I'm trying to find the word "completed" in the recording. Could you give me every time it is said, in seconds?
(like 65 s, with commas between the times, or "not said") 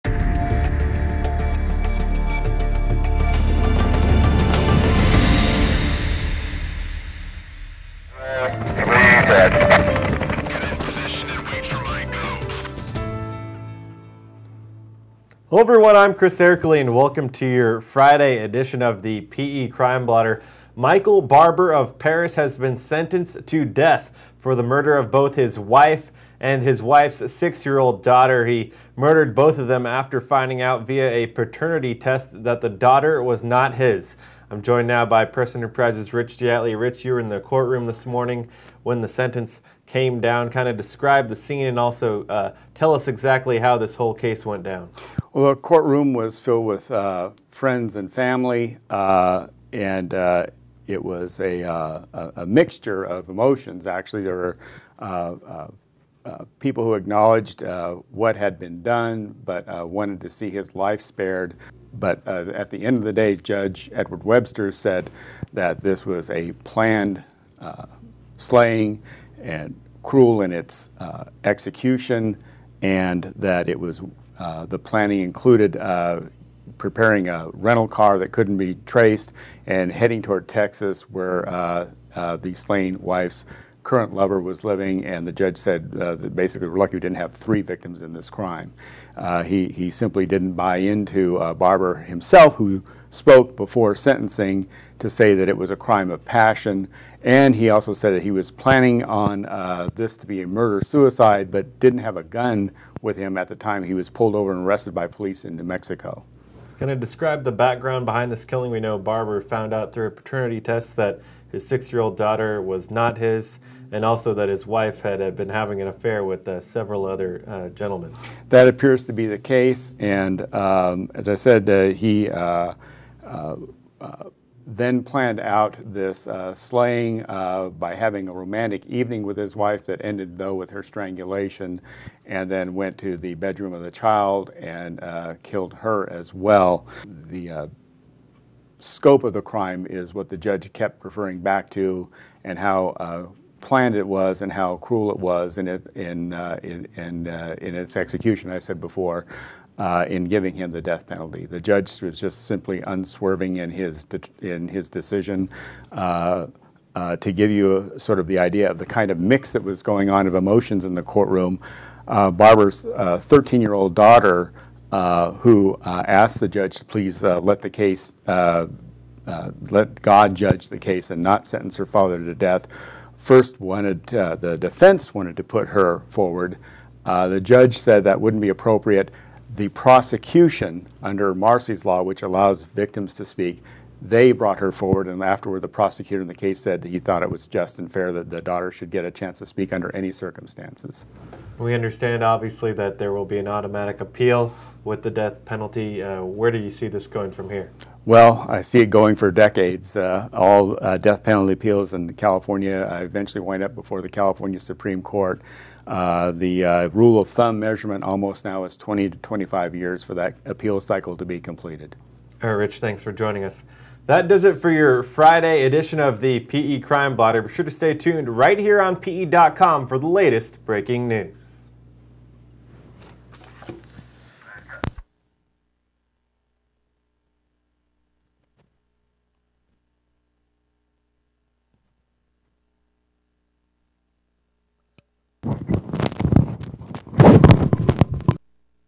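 211 s.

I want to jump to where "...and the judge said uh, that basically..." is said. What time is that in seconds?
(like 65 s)
85 s.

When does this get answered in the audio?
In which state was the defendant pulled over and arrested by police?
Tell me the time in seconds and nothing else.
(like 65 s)
105 s.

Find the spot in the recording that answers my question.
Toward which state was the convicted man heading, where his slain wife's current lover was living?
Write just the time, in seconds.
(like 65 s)
80 s.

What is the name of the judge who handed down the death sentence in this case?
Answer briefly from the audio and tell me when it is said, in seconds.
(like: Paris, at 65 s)
Edward Webster, at 63 s.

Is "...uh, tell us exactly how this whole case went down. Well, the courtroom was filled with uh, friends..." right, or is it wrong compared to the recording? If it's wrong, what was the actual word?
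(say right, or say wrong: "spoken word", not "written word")
right.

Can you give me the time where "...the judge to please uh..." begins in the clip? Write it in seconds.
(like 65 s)
166 s.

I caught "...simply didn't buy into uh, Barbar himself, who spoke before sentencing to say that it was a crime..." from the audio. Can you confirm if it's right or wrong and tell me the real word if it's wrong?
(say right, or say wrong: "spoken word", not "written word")
right.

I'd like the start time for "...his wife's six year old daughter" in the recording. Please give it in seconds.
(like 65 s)
26 s.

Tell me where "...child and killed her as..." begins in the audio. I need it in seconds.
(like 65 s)
133 s.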